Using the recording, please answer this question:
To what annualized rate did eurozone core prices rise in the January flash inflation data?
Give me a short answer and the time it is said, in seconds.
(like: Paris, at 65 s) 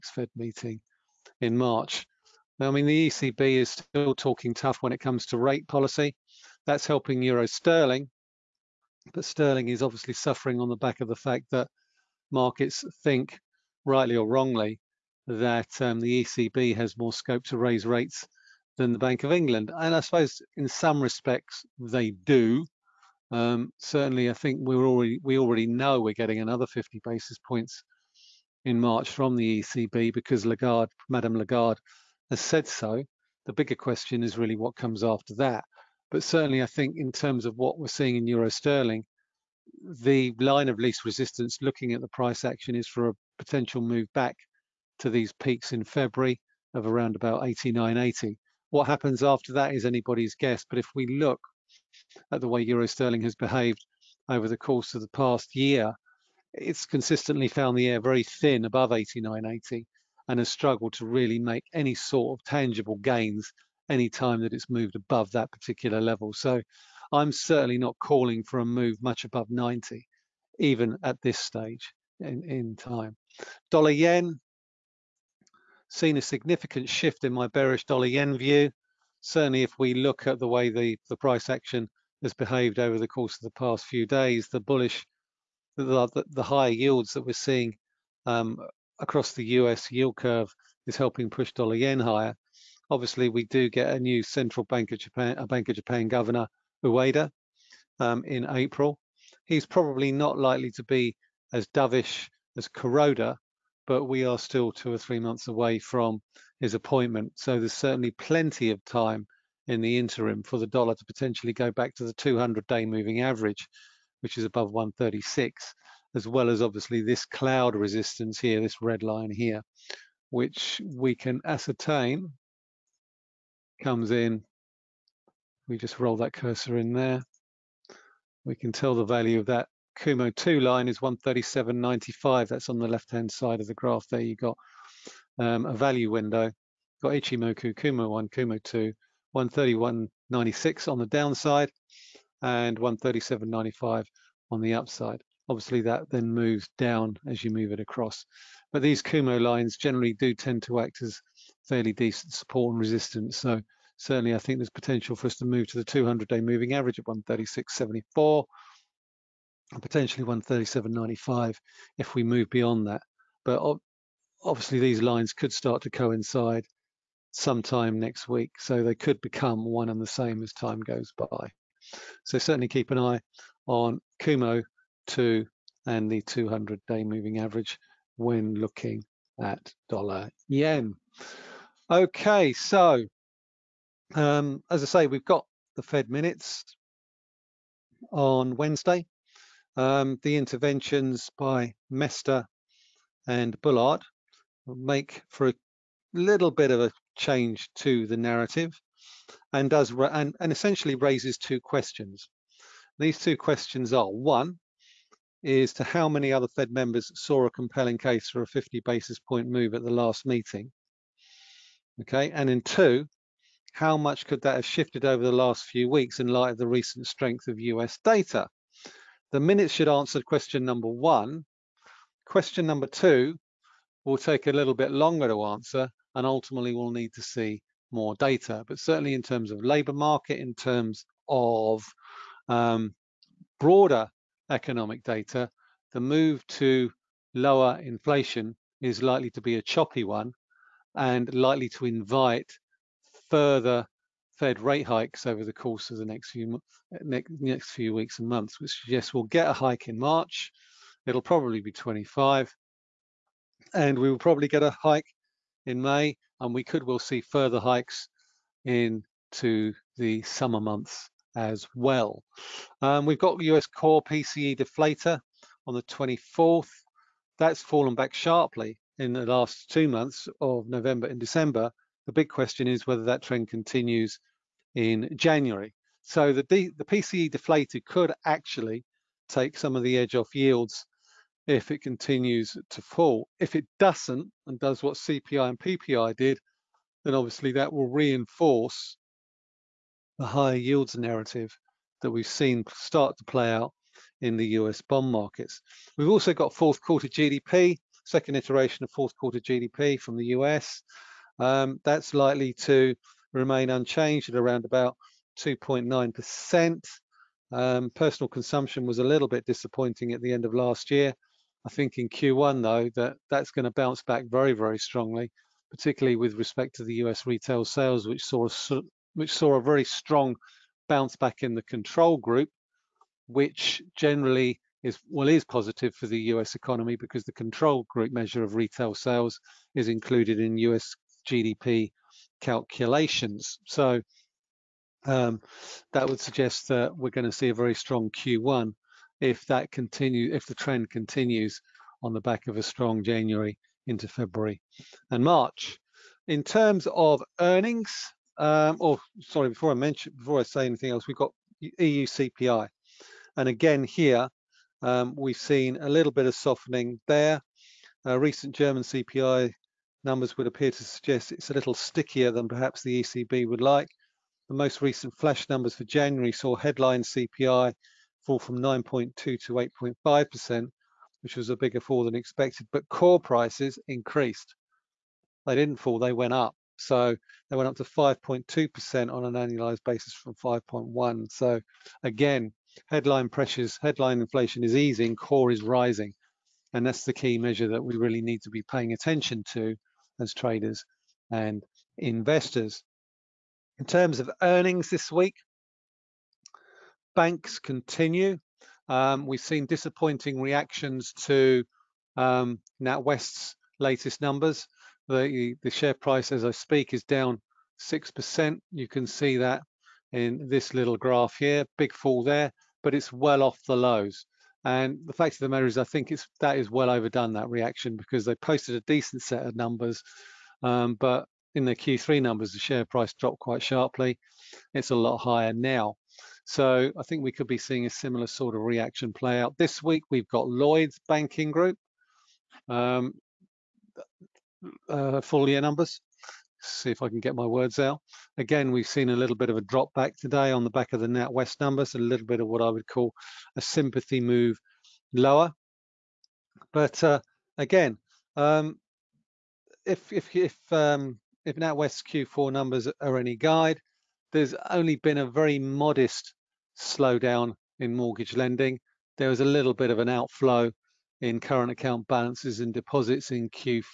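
5.2%, at 377 s.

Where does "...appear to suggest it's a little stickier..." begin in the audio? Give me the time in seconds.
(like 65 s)
360 s.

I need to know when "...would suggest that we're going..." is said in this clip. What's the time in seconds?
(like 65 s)
336 s.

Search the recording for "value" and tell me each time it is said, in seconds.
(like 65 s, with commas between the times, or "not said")
129 s, 135 s.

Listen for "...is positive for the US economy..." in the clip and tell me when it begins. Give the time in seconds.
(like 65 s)
325 s.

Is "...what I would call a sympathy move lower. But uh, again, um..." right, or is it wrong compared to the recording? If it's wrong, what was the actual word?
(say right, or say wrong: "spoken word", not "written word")
right.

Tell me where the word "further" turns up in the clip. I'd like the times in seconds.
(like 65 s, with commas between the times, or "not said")
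243 s, 257 s.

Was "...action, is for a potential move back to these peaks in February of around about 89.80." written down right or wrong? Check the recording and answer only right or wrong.
right.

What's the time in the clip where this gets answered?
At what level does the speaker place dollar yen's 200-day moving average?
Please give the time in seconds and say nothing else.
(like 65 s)
157 s.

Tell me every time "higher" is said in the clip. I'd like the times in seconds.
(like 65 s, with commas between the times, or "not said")
86 s, 91 s, 290 s, 425 s.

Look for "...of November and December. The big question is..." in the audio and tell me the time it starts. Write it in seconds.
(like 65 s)
270 s.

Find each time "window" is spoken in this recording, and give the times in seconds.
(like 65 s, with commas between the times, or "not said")
136 s.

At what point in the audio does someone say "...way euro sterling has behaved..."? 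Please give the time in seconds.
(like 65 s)
52 s.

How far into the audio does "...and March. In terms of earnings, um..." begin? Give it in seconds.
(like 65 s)
345 s.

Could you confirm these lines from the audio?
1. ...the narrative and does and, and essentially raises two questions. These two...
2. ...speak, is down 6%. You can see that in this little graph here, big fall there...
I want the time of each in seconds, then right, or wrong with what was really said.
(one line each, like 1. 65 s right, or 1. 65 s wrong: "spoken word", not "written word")
1. 198 s right
2. 406 s right.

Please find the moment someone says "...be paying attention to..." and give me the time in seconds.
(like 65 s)
388 s.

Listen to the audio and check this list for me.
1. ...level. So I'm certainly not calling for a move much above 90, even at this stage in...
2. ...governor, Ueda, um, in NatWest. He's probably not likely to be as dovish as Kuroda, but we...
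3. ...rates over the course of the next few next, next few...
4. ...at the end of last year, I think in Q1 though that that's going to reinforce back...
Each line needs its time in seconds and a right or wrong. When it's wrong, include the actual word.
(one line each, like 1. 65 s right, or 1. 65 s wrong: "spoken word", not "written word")
1. 65 s right
2. 96 s wrong: "April", not "NatWest"
3. 244 s wrong: "hikes", not "rates"
4. 310 s wrong: "bounce", not "reinforce".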